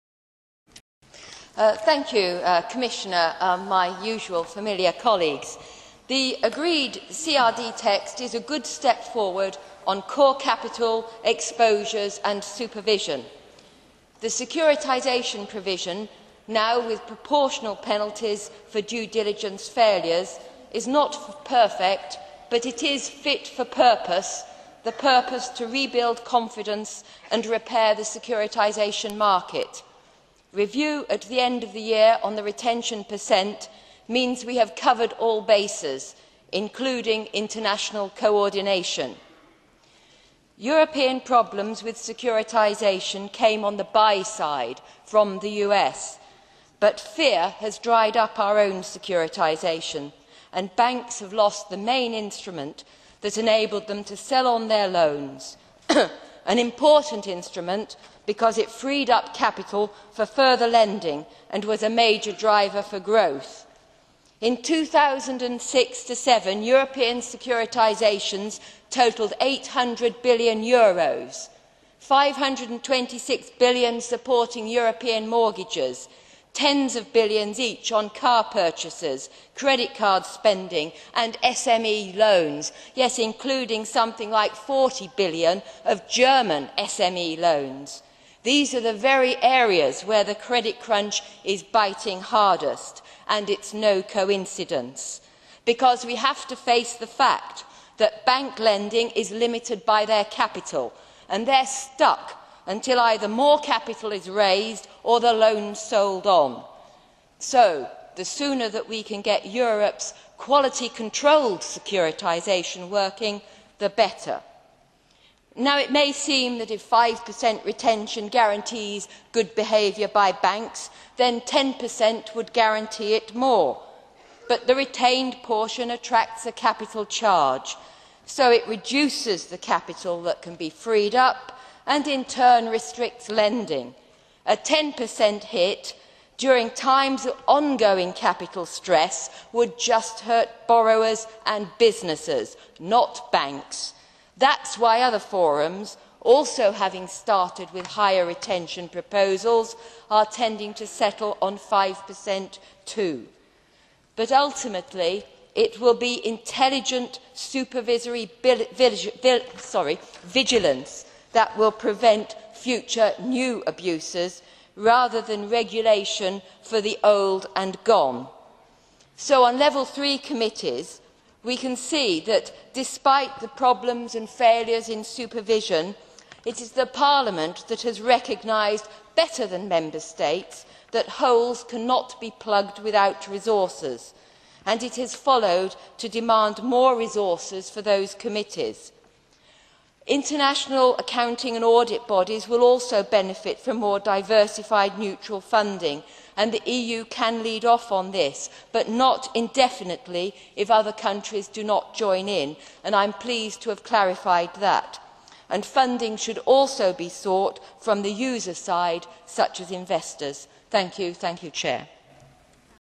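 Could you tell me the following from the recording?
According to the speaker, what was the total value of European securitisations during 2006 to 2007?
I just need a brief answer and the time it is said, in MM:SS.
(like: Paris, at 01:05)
800 billion euros, at 01:09.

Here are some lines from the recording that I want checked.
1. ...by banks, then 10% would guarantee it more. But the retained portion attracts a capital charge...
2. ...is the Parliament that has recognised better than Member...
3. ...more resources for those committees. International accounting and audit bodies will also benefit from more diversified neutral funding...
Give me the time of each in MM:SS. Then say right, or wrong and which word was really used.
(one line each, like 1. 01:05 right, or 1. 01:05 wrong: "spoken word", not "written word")
1. 02:00 right
2. 02:56 right
3. 03:06 right.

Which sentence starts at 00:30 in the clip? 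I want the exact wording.
Review at the end of the year on the retention percent means we have covered all bases, including international coordination.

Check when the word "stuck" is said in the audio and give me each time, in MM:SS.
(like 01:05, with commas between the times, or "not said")
01:41.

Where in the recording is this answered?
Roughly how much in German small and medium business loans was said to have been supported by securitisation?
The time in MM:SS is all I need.
01:24.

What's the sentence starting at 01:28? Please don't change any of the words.
These are the very areas where the credit crunch is biting hardest, and it's no coincidence.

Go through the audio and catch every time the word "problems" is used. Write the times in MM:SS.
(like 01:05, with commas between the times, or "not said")
00:41, 02:53.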